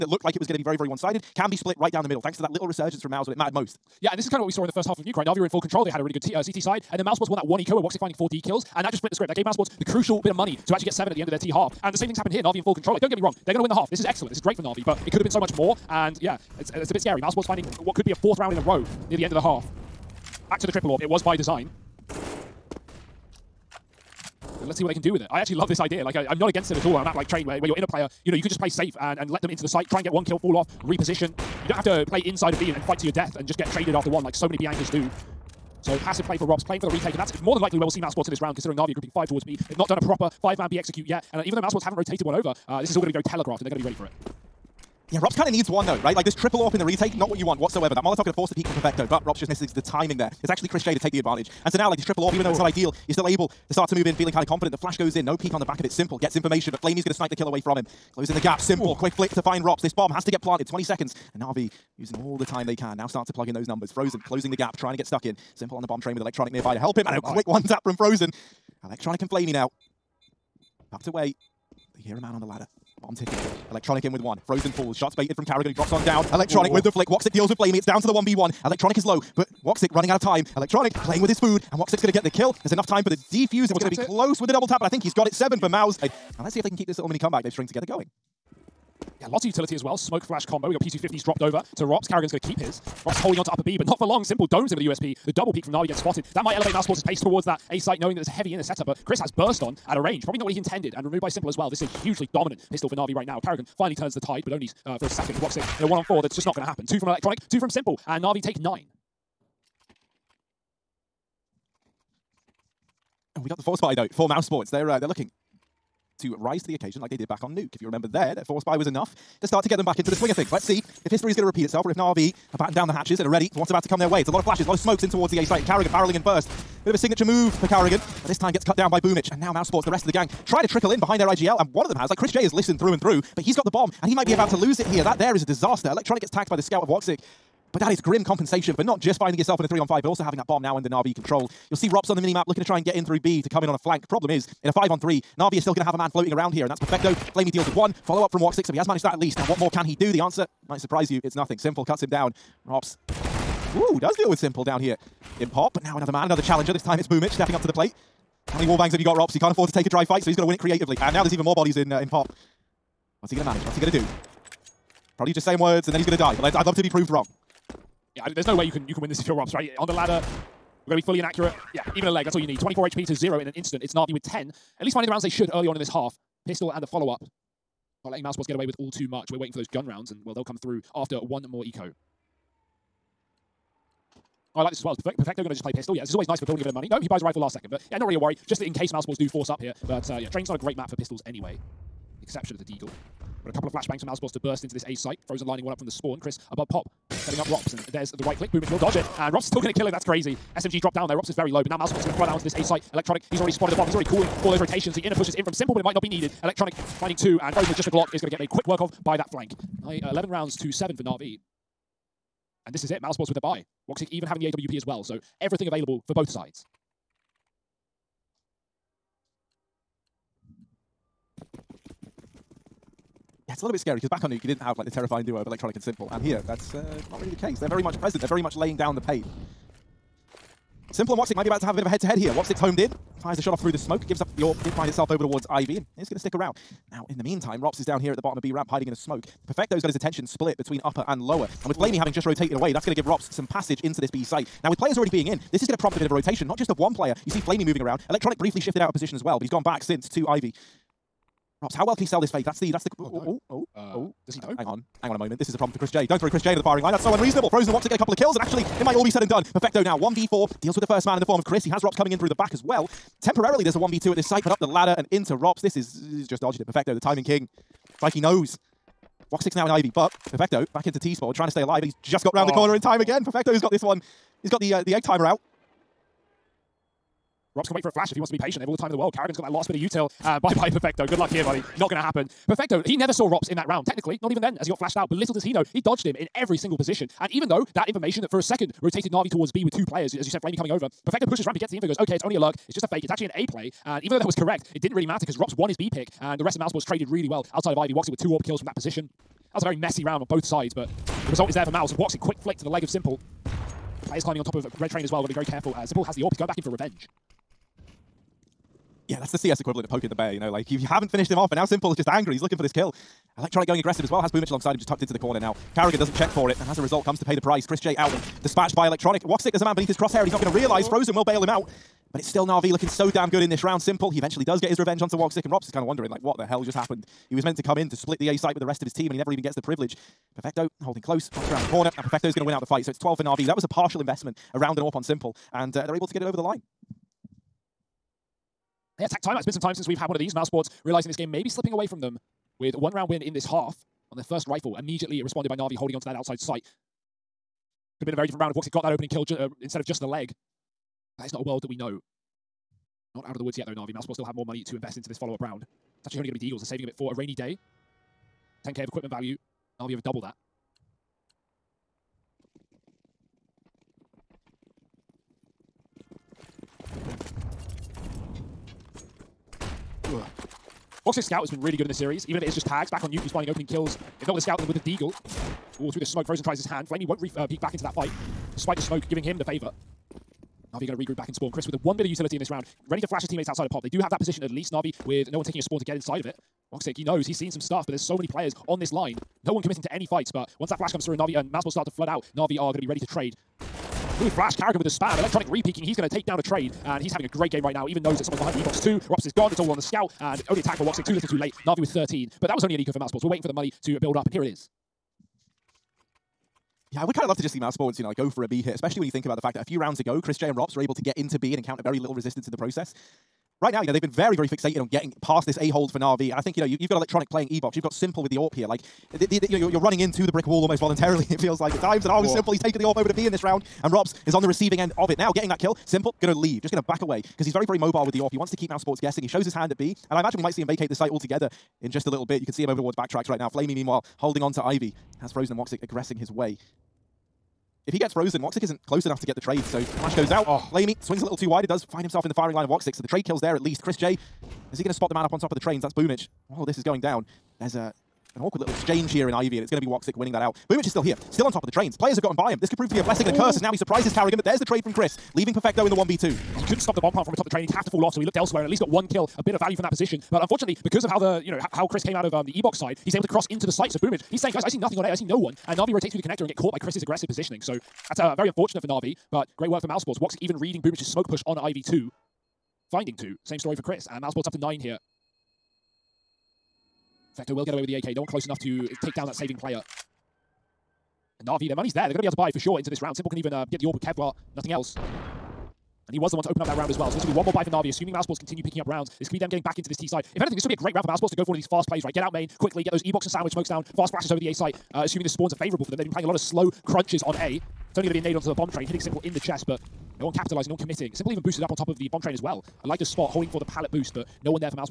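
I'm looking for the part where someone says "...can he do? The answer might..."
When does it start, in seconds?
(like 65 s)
149 s.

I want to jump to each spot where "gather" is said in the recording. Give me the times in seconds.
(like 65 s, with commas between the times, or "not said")
not said.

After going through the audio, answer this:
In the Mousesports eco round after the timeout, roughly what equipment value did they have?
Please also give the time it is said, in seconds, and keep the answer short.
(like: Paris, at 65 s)
10k, at 358 s.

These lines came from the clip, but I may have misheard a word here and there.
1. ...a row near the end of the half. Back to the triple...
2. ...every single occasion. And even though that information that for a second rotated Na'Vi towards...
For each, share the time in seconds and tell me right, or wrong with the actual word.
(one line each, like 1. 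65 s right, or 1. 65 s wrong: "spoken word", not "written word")
1. 18 s right
2. 286 s wrong: "position", not "occasion".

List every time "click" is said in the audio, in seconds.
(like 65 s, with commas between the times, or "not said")
198 s.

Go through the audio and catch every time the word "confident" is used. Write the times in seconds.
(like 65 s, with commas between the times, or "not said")
54 s.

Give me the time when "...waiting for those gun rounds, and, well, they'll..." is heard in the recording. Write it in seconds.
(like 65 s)
179 s.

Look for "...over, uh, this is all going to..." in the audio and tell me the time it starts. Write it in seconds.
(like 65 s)
42 s.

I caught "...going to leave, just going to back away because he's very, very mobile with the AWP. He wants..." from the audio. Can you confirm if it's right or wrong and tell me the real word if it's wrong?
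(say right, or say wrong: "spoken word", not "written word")
right.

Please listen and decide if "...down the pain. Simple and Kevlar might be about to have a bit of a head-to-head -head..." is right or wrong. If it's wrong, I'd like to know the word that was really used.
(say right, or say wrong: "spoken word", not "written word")
wrong: "Woxic", not "Kevlar".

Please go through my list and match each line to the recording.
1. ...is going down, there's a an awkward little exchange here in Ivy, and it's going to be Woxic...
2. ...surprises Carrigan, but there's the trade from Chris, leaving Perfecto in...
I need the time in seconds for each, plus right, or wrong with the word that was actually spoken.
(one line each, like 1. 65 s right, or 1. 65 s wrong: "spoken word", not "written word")
1. 446 s right
2. 453 s right.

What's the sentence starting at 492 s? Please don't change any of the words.
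Get out main quickly, get those E-Box and Sandwich smokes down, fast flashes over the A site.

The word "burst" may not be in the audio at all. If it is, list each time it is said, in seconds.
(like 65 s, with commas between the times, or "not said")
99 s, 194 s.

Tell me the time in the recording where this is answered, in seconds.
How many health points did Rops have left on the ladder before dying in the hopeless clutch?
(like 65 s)
172 s.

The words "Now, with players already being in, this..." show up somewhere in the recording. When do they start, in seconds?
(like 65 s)
244 s.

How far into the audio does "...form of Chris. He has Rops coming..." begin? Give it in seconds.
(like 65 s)
261 s.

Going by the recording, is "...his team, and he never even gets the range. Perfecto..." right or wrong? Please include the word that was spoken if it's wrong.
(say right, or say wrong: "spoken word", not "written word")
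wrong: "privilege", not "range".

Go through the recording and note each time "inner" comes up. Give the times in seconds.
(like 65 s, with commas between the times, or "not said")
98 s, 204 s.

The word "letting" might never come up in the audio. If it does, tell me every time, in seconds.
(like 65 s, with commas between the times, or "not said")
178 s.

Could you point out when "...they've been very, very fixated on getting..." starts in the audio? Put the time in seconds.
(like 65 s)
413 s.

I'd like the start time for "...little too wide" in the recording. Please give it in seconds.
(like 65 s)
441 s.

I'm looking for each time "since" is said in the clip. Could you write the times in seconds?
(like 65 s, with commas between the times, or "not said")
249 s, 339 s.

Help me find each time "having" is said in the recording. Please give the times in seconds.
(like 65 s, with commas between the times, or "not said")
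140 s, 214 s, 241 s, 397 s.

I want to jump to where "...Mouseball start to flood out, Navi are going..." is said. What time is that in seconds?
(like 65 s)
391 s.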